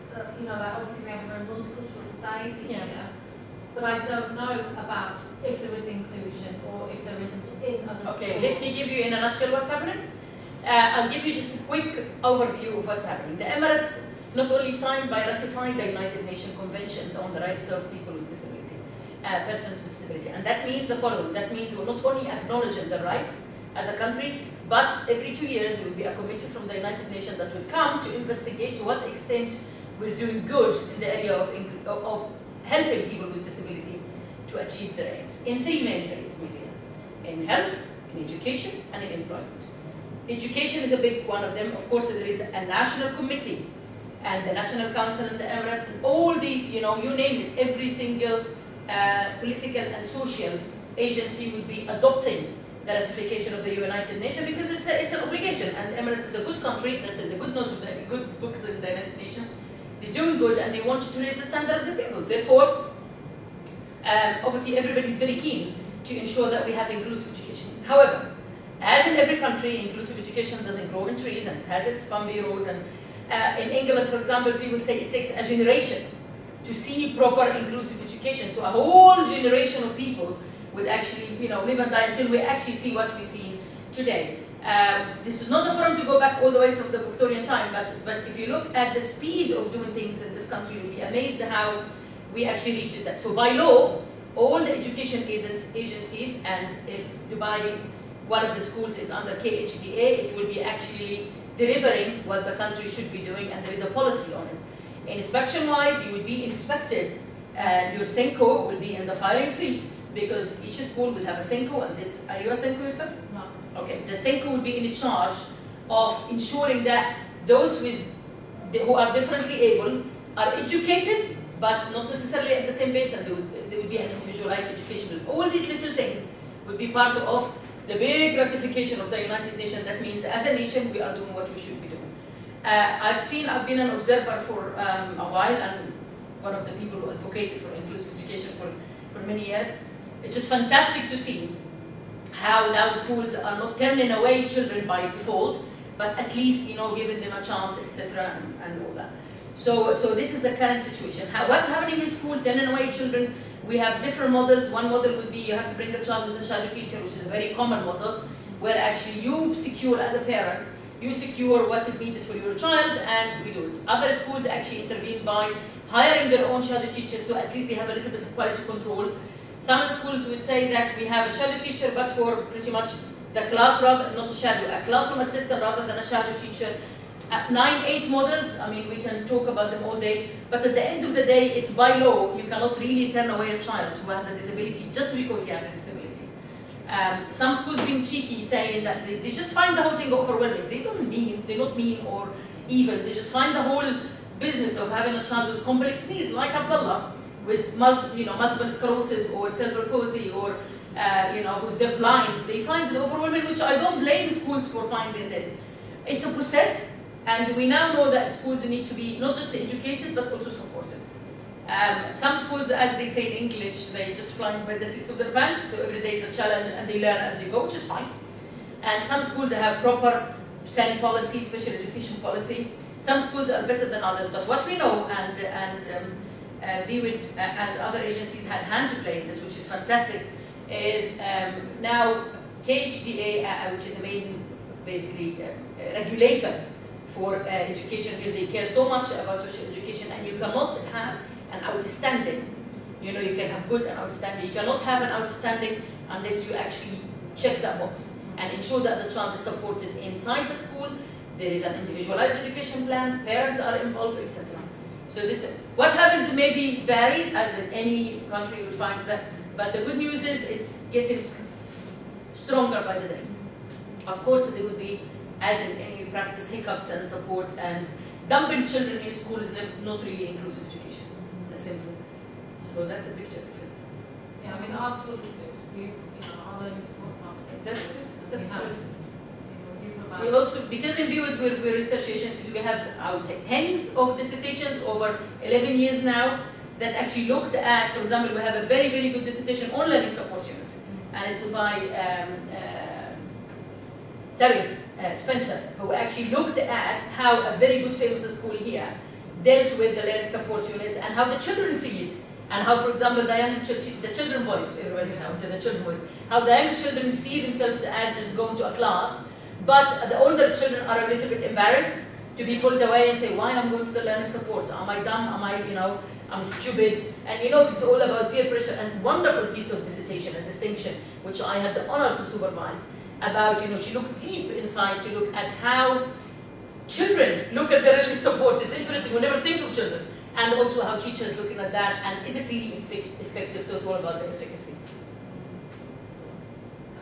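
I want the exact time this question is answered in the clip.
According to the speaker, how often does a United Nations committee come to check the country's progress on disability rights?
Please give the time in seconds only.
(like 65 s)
25 s.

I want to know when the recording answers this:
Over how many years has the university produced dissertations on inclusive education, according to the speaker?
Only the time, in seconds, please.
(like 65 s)
285 s.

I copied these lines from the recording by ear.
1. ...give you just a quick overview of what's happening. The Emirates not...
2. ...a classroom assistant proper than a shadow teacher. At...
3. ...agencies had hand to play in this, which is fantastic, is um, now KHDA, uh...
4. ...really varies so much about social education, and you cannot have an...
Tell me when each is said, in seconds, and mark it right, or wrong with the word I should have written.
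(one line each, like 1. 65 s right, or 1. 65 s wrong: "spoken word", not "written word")
1. 11 s right
2. 174 s wrong: "rather", not "proper"
3. 227 s right
4. 238 s wrong: "cares", not "varies".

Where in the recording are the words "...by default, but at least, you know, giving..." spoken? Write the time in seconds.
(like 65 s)
144 s.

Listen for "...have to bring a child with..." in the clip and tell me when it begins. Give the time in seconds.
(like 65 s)
155 s.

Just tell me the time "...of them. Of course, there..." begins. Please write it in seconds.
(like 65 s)
41 s.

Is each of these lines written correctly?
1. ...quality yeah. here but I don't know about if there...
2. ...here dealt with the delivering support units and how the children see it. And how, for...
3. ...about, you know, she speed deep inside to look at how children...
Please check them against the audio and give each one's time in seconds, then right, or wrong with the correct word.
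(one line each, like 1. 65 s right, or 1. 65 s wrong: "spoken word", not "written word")
1. 2 s wrong: "society", not "quality"
2. 298 s wrong: "learning", not "delivering"
3. 323 s wrong: "looked", not "speed".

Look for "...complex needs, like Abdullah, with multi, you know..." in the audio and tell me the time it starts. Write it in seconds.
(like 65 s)
195 s.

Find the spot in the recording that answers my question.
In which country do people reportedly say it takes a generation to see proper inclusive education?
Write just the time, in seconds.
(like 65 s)
73 s.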